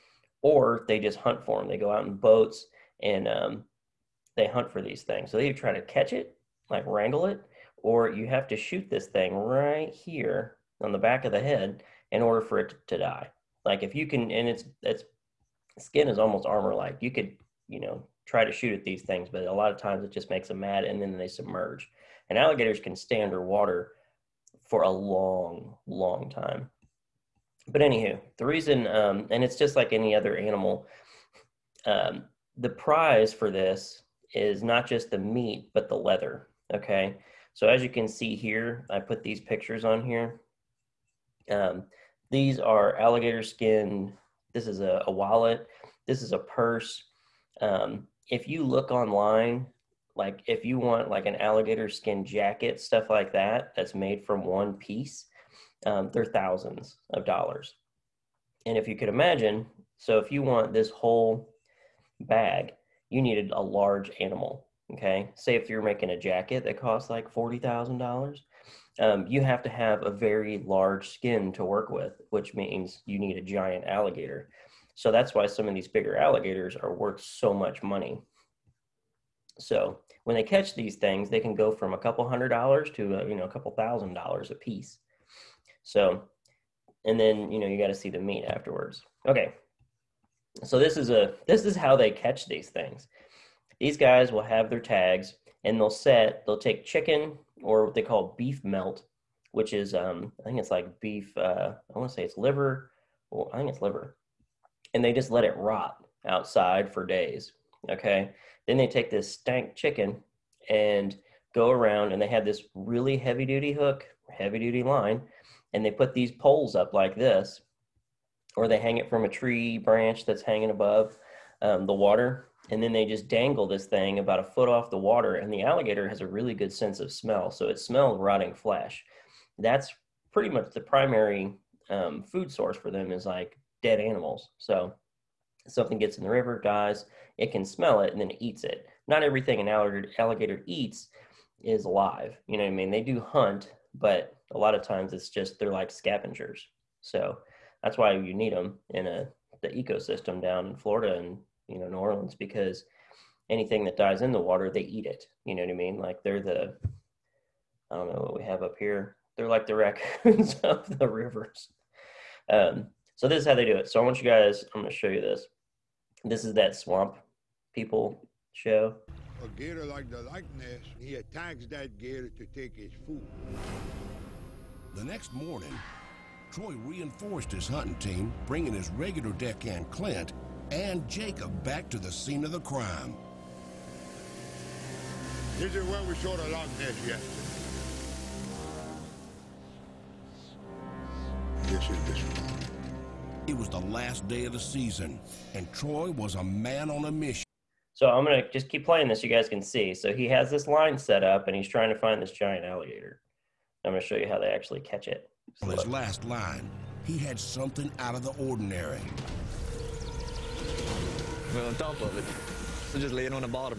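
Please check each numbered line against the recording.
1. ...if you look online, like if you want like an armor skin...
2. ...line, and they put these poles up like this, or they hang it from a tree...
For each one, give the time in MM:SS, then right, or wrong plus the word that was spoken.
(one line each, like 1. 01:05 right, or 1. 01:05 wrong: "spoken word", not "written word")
1. 00:48 wrong: "alligator", not "armor"
2. 01:54 right.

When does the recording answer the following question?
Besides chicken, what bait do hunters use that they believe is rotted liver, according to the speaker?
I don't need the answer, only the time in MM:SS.
01:38.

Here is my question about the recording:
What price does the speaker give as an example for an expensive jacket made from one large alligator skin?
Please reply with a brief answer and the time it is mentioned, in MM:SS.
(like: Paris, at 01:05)
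$40,000, at 01:07.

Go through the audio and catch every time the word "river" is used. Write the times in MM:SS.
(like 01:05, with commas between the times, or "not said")
02:16, 02:41.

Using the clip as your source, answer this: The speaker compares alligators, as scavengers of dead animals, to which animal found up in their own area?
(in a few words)
raccoons.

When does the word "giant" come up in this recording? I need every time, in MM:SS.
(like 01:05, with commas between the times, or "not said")
01:13, 03:22.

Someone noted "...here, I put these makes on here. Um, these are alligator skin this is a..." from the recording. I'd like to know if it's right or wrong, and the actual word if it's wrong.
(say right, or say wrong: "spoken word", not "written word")
wrong: "pictures", not "makes".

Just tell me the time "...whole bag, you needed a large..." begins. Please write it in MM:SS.
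01:00.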